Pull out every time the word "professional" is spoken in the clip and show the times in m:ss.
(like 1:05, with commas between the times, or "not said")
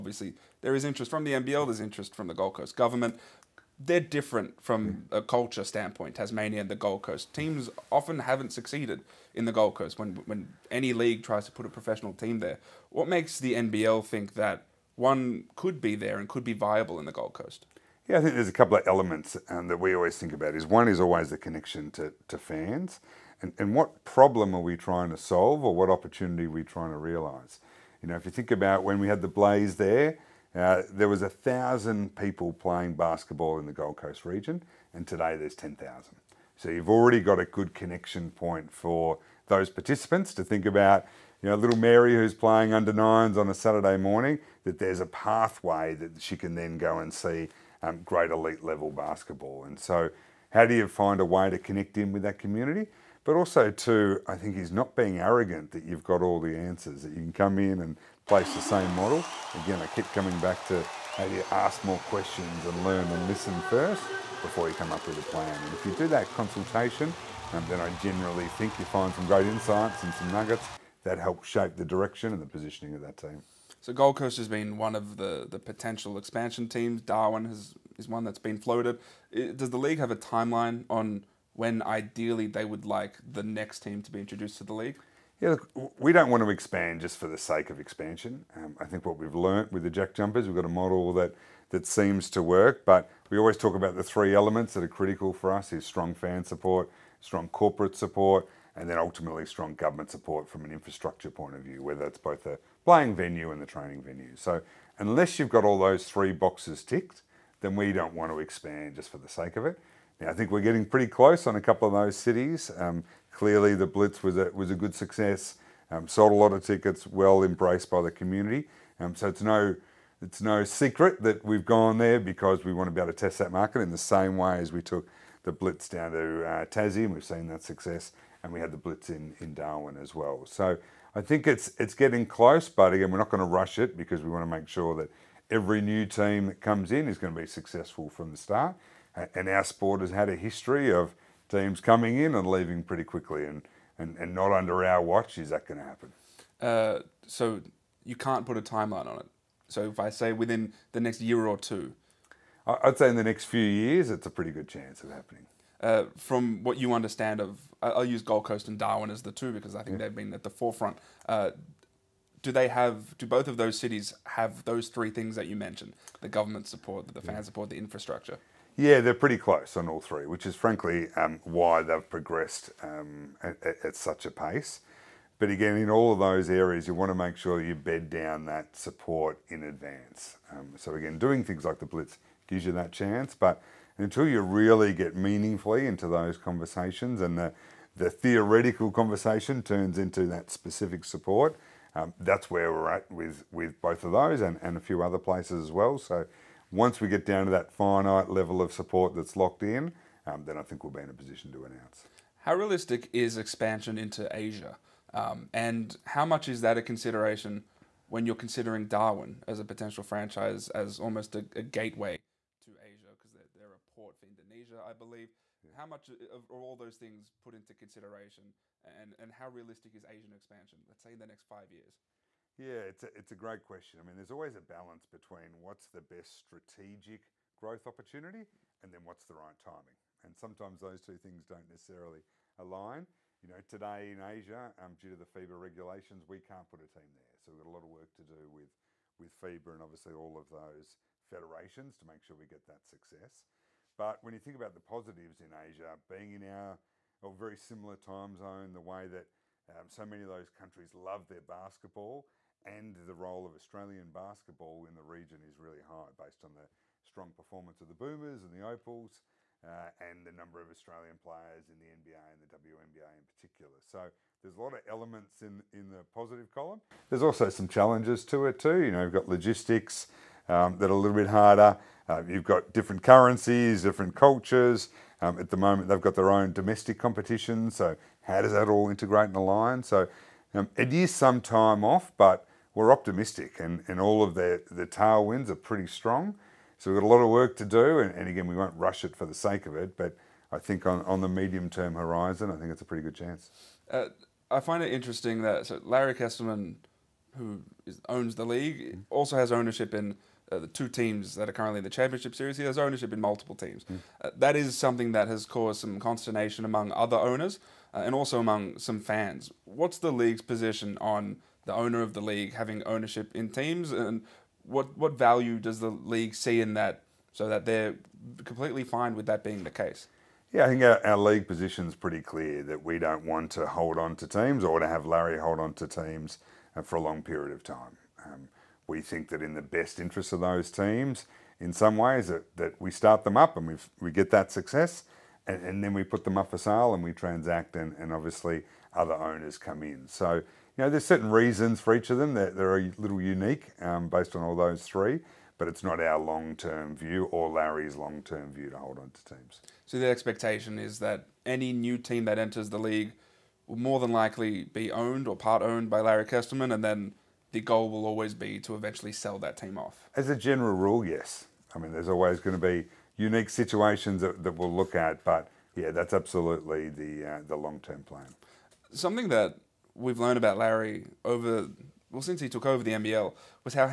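0:11.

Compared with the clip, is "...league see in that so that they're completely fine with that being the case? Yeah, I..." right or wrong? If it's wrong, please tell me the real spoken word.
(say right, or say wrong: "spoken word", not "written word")
right.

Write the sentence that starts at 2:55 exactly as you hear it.
But again, in all of those areas, you want to make sure you bed down that support in advance.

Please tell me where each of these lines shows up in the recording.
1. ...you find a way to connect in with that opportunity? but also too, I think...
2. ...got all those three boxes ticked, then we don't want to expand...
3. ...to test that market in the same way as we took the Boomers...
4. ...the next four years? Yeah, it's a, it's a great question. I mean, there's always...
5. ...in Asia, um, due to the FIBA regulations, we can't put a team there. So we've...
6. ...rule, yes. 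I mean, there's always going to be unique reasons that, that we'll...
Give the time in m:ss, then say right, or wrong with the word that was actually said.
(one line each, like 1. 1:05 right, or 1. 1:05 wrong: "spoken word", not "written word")
1. 0:50 wrong: "community", not "opportunity"
2. 1:45 right
3. 2:03 wrong: "Blitz", not "Boomers"
4. 3:41 wrong: "five", not "four"
5. 3:54 right
6. 6:00 wrong: "situations", not "reasons".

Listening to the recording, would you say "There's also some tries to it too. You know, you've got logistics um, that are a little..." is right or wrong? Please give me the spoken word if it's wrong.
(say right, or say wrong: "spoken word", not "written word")
wrong: "challenges", not "tries".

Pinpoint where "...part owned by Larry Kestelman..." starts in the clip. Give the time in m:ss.
5:55.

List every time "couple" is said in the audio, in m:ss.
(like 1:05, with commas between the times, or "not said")
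0:18, 1:51.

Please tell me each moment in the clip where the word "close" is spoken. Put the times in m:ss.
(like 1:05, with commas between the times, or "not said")
1:51, 2:12, 2:49.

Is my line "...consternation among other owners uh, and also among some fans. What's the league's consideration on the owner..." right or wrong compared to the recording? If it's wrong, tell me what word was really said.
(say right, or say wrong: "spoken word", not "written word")
wrong: "position", not "consideration".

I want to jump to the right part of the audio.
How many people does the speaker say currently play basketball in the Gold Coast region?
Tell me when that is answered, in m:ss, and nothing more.
0:35.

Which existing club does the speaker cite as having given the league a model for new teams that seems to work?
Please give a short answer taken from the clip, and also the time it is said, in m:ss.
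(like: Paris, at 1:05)
Jack Jumpers, at 1:29.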